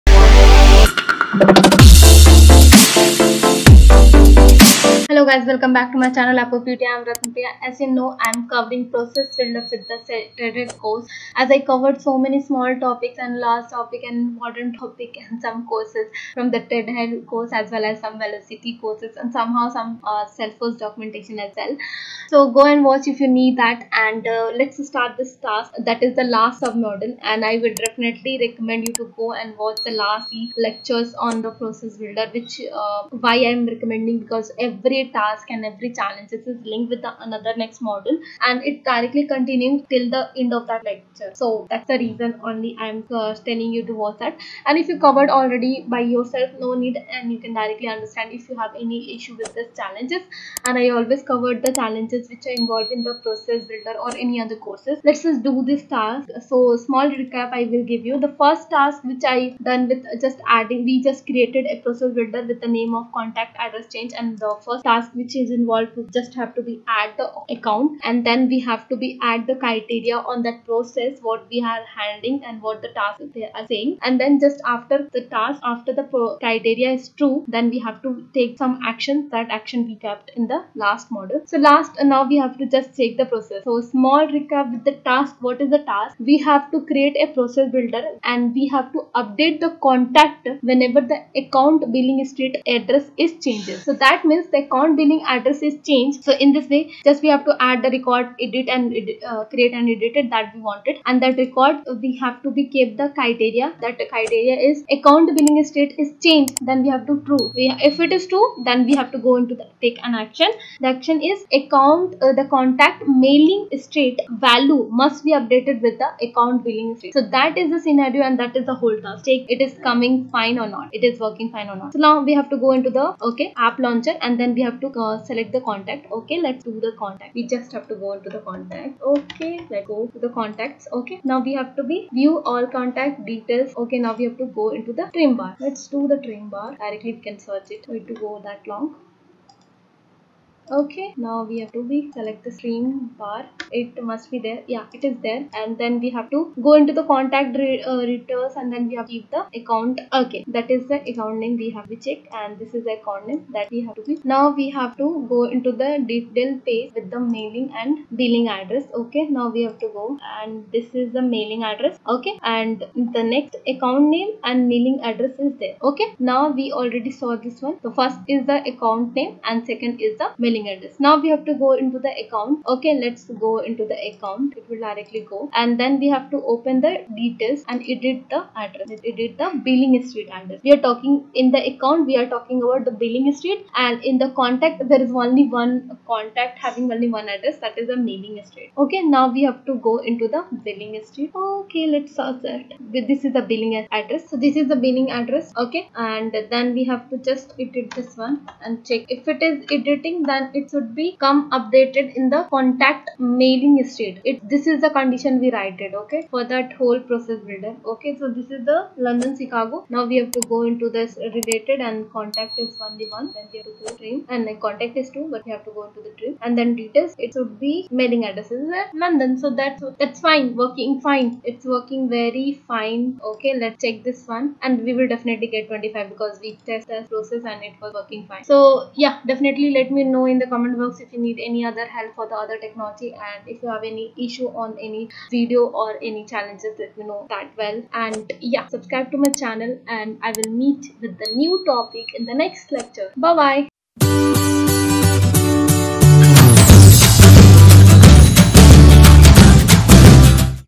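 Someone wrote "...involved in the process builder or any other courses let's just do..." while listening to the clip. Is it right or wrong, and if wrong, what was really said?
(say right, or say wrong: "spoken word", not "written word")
right.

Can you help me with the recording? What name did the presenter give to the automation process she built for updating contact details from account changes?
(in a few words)
Contact Address Change.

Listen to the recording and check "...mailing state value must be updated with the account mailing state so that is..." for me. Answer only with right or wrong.
wrong.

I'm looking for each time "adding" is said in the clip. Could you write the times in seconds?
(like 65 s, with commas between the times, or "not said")
60 s.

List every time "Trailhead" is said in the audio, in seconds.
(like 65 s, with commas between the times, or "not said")
10 s, 16 s.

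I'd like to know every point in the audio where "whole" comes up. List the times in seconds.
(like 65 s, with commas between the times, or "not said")
118 s, 206 s.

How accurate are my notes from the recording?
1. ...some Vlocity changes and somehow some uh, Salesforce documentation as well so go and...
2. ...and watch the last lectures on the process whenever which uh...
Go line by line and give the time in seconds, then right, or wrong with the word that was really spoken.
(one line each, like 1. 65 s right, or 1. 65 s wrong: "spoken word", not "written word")
1. 18 s wrong: "courses", not "changes"
2. 29 s wrong: "builder", not "whenever".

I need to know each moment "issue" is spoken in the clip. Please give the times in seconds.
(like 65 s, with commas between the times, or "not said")
49 s, 234 s.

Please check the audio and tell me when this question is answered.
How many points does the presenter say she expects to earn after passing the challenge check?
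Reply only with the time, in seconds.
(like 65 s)
225 s.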